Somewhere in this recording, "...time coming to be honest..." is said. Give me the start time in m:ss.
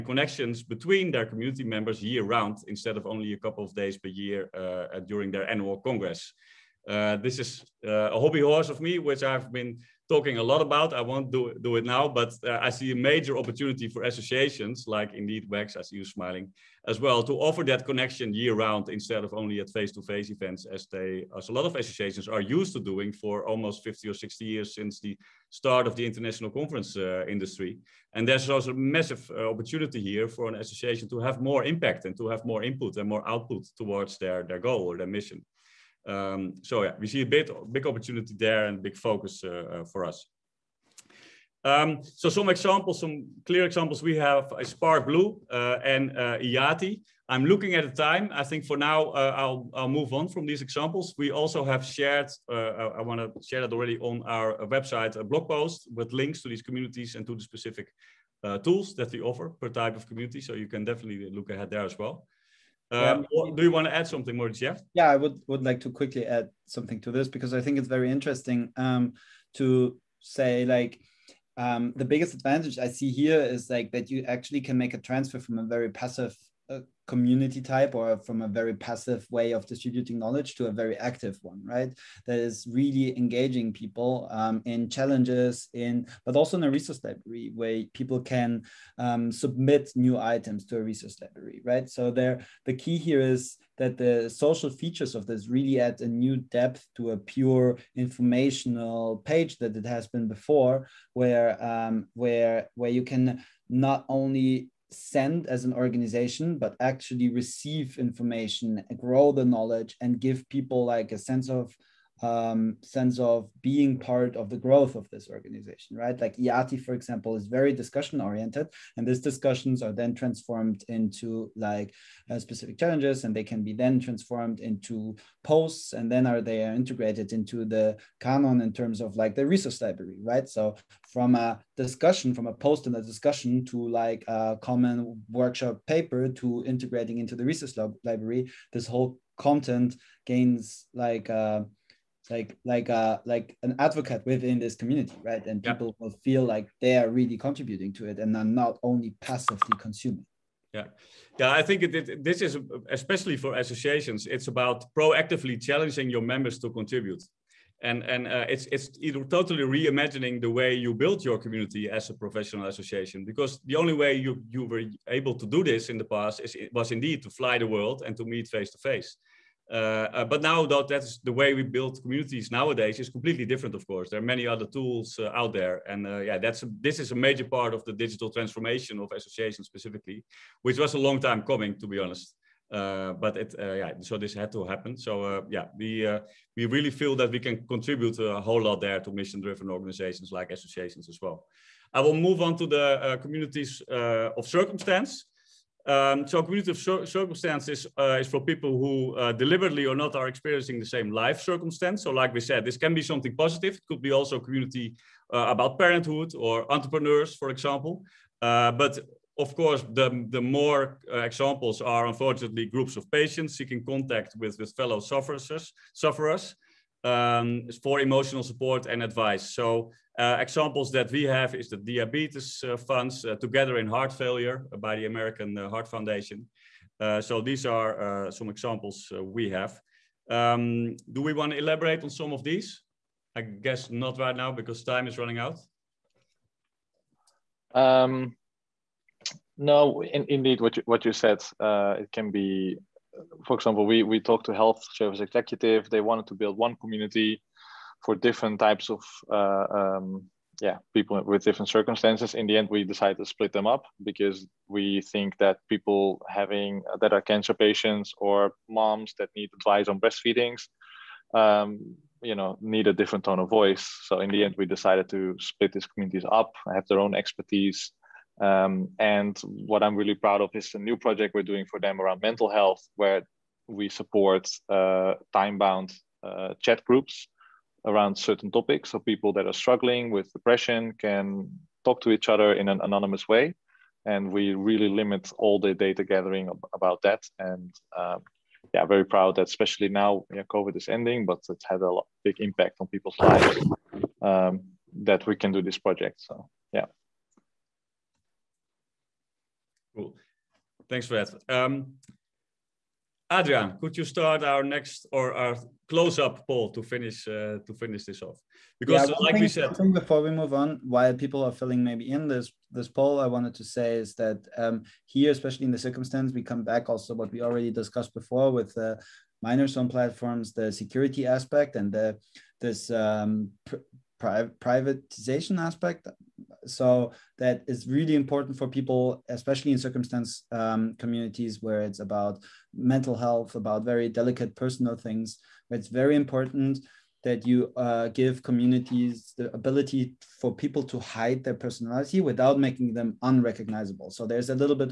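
3:01.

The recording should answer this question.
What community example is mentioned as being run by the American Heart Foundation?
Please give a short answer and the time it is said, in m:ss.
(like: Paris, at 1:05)
Together in Heart Failure, at 3:43.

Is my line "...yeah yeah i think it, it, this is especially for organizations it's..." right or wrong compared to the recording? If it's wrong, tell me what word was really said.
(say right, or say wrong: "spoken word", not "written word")
wrong: "associations", not "organizations".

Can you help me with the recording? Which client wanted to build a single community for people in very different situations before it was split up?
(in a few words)
Health Service Executive.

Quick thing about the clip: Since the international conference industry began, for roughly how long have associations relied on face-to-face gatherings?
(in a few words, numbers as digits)
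50 or 60 years.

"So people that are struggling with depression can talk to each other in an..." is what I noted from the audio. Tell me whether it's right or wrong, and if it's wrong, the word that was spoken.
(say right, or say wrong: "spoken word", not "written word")
right.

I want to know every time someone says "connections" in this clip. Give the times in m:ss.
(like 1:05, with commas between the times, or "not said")
0:00, 0:17.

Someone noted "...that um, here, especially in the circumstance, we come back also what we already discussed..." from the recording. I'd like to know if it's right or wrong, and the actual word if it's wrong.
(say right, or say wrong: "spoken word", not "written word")
right.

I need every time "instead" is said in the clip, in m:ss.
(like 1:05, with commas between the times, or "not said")
0:02, 0:18.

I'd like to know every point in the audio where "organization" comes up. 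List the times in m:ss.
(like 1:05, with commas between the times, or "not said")
1:45, 1:55, 3:09.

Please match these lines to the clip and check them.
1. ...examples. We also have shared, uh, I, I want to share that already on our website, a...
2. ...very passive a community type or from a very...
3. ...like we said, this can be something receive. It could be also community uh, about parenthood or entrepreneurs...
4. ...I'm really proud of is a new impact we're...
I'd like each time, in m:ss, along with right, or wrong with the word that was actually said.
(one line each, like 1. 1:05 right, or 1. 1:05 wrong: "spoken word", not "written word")
1. 0:50 right
2. 1:15 right
3. 3:22 wrong: "positive", not "receive"
4. 4:29 wrong: "project", not "impact".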